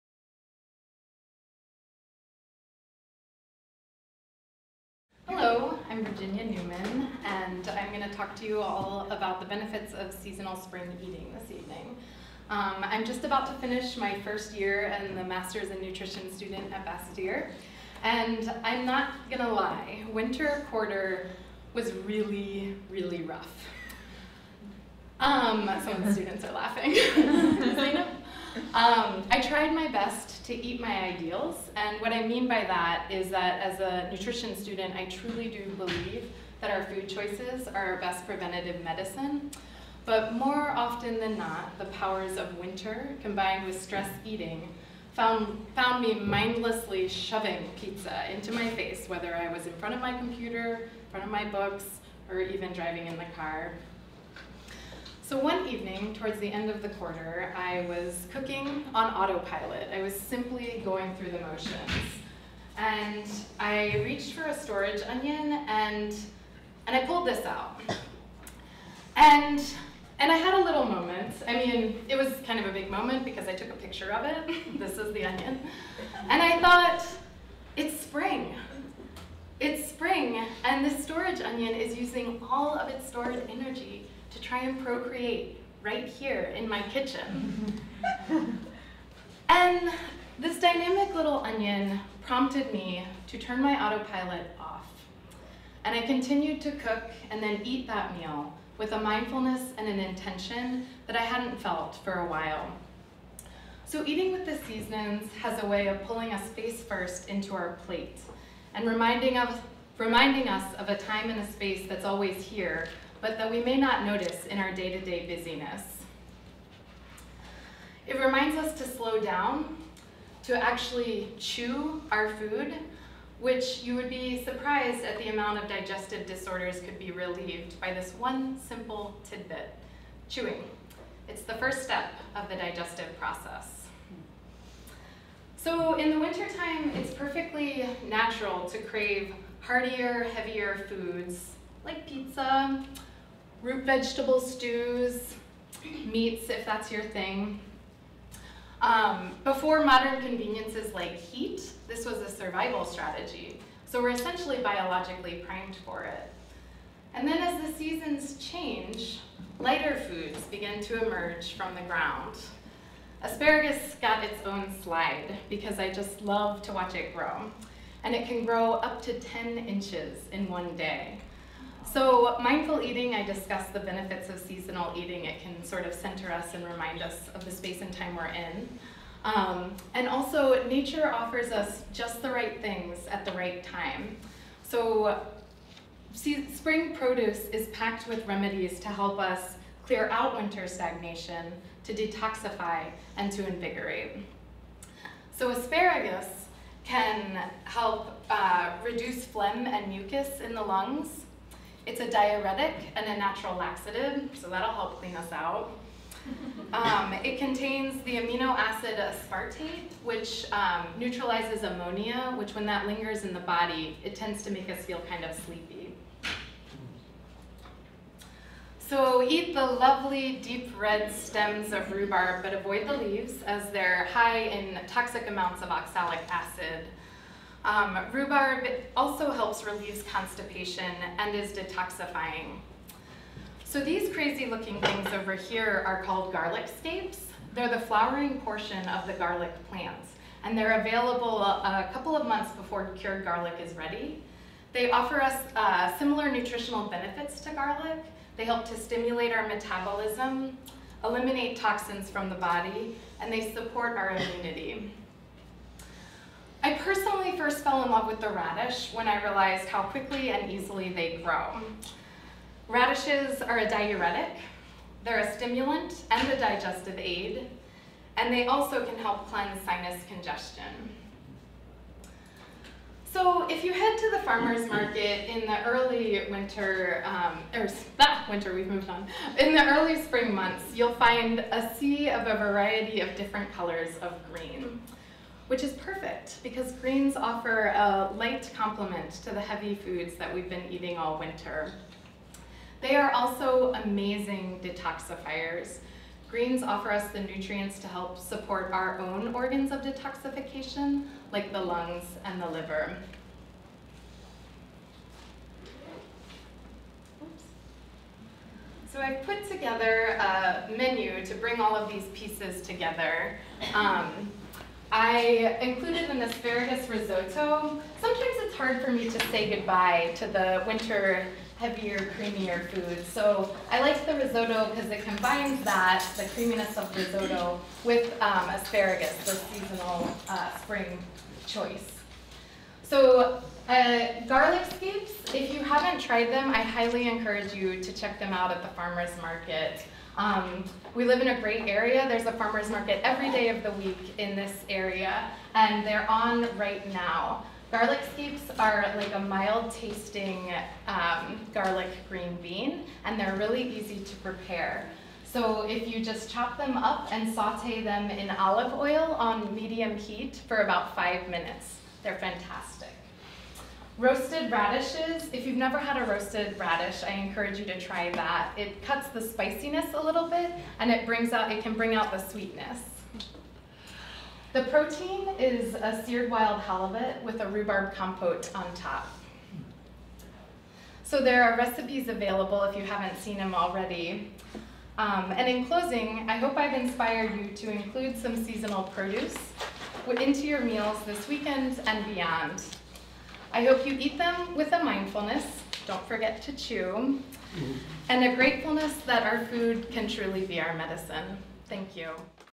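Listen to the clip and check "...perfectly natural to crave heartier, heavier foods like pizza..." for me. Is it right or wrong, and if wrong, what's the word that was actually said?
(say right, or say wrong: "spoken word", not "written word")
right.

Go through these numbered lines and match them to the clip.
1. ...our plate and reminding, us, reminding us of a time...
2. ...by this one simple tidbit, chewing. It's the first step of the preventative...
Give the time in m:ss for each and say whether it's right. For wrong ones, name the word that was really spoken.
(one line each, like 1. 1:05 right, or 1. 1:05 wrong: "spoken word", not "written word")
1. 1:47 right
2. 2:07 wrong: "digestive", not "preventative".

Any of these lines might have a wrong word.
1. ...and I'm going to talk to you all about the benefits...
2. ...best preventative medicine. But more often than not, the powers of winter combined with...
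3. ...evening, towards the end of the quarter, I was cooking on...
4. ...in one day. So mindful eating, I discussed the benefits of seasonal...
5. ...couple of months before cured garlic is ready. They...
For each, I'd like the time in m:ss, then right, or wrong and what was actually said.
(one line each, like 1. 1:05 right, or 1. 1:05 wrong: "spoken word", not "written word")
1. 0:07 right
2. 0:37 right
3. 0:55 right
4. 2:50 right
5. 4:01 right.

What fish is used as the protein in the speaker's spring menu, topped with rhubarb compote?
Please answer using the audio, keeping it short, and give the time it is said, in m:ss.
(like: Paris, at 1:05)
wild halibut, at 6:16.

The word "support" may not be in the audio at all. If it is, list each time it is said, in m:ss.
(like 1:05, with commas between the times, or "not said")
4:13, 4:58.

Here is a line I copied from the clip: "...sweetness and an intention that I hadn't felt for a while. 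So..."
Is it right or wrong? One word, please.
wrong.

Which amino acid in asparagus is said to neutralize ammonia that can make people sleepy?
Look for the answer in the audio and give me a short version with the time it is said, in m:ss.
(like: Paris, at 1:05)
aspartate, at 3:28.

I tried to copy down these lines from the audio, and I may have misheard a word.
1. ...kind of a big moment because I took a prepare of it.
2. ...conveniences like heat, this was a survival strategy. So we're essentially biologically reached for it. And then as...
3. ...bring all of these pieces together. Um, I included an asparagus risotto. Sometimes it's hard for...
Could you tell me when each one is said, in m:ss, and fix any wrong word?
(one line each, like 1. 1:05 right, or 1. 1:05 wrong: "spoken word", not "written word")
1. 1:12 wrong: "picture", not "prepare"
2. 2:30 wrong: "primed", not "reached"
3. 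5:11 right.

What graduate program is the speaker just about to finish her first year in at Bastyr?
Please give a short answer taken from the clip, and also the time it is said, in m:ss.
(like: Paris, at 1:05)
Master's in Nutrition, at 0:15.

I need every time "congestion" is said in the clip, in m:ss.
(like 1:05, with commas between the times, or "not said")
4:30.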